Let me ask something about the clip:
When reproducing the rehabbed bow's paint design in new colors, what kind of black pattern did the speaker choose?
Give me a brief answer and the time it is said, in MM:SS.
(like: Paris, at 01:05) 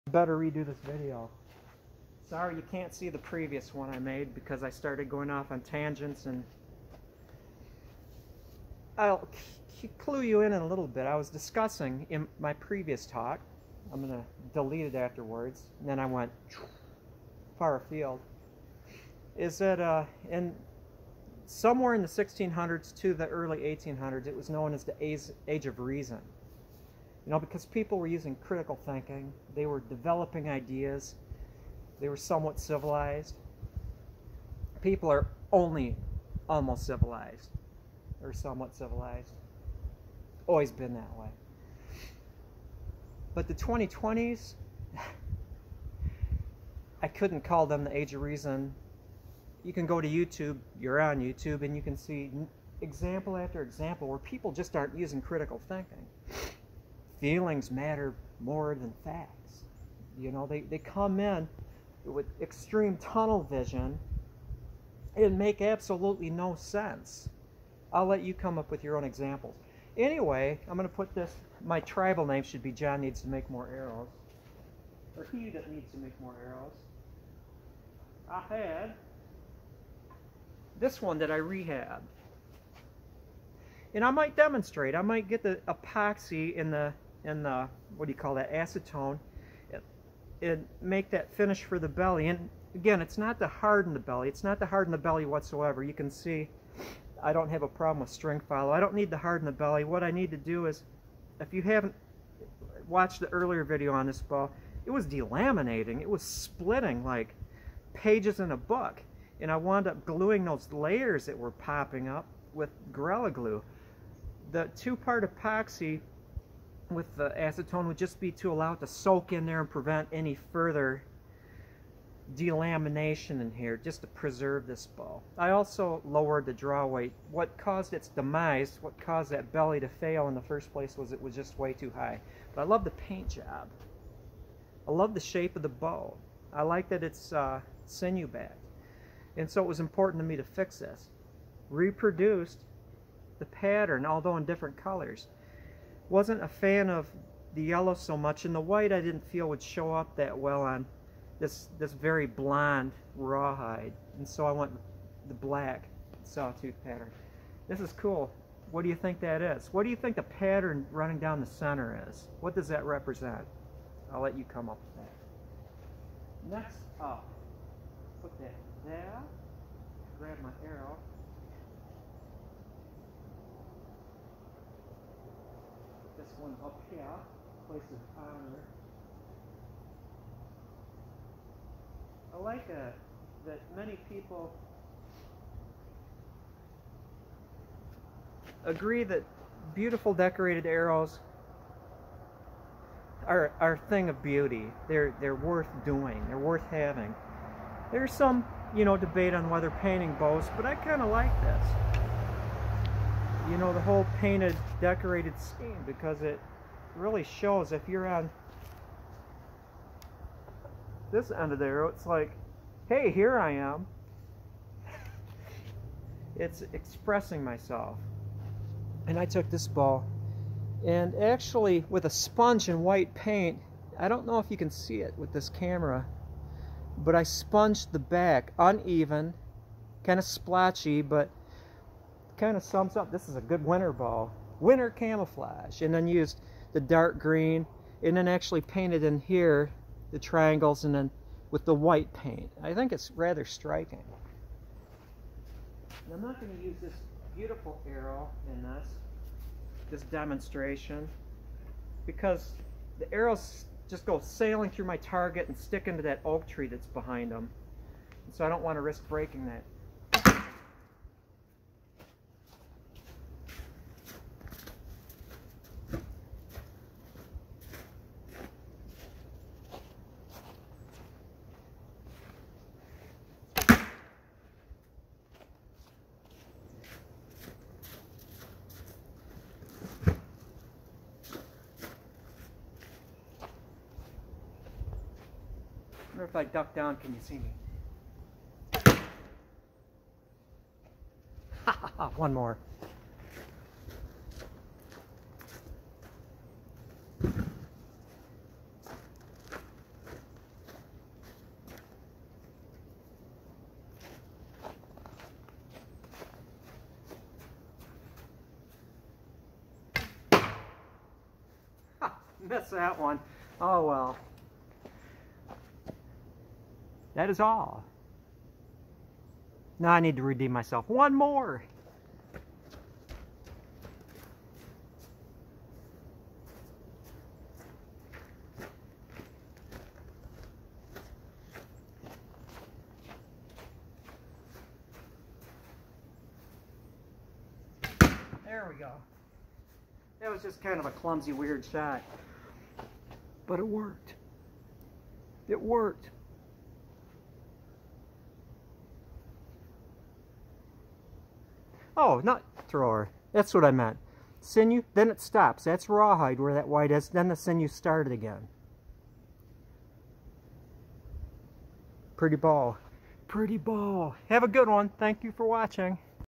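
sawtooth, at 02:36.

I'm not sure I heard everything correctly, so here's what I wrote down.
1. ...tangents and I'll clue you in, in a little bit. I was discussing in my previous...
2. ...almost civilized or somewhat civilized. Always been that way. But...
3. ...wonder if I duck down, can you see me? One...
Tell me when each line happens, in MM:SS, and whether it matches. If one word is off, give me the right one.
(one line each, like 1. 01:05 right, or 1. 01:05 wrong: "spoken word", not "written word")
1. 00:05 right
2. 00:36 right
3. 04:46 right.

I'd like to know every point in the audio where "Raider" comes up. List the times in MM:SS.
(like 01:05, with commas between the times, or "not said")
not said.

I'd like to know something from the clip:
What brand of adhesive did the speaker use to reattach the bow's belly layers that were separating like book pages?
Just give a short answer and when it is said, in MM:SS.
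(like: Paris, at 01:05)
Gorilla Glue, at 01:52.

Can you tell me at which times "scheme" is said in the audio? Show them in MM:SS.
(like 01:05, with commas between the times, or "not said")
03:25.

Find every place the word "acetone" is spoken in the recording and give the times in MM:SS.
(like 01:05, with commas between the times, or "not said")
01:28, 01:57.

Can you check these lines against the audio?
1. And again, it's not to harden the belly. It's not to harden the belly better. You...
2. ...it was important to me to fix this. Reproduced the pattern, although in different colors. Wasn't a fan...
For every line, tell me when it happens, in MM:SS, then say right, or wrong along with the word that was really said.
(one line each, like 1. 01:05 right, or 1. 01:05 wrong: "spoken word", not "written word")
1. 01:32 wrong: "whatsoever", not "better"
2. 02:19 right.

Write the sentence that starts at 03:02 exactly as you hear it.
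I like a, uh, that many people agree that beautiful decorated arrows are, are a thing of beauty.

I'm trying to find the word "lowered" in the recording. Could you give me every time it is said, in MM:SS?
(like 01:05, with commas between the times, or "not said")
02:06.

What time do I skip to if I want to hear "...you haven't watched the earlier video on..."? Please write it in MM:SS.
01:41.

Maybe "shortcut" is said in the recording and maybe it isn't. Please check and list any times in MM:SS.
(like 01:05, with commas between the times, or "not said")
not said.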